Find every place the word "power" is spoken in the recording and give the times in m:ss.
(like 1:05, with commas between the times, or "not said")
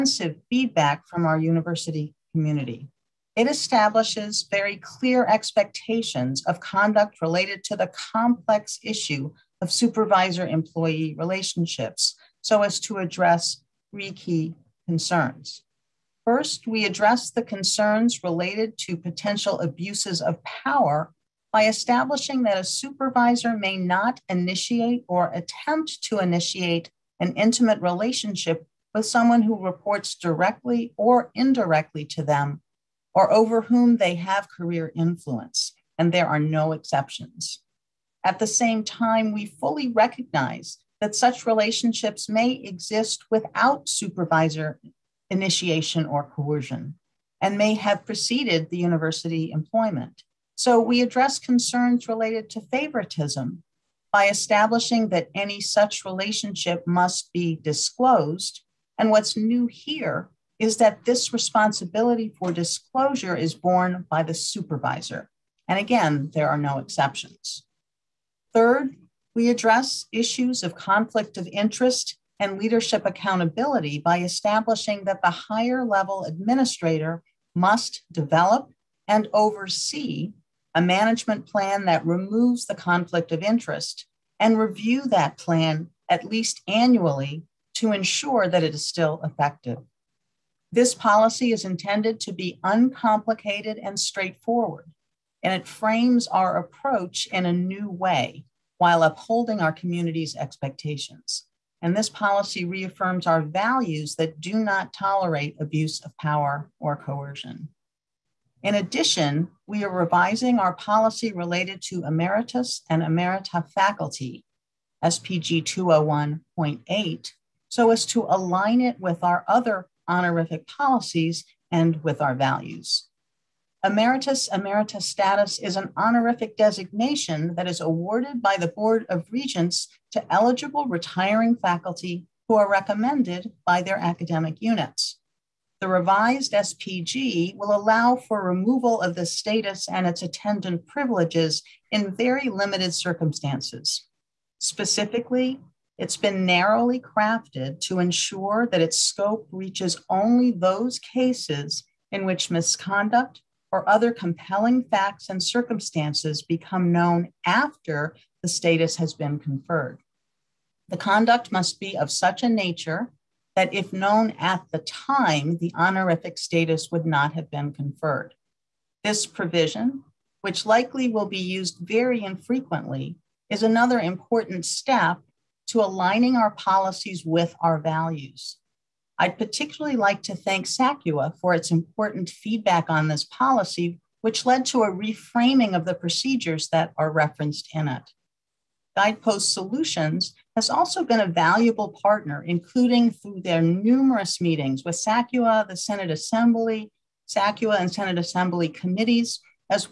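0:20, 1:46.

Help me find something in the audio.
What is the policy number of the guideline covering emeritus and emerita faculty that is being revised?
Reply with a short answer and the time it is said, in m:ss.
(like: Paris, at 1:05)
SPG 201.8, at 1:55.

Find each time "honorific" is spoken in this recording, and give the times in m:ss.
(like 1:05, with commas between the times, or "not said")
2:00, 2:05, 2:45.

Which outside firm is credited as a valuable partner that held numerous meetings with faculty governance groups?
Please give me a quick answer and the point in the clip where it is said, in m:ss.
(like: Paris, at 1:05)
Guidepost Solutions, at 3:08.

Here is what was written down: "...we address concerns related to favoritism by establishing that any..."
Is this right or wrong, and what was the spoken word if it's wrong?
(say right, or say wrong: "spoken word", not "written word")
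right.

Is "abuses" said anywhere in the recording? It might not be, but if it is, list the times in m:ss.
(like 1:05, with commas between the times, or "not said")
0:19, 1:45.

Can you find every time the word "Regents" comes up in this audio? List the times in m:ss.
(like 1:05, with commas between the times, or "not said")
2:09.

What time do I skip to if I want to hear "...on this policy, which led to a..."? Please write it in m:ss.
3:02.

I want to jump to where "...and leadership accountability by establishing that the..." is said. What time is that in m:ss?
1:12.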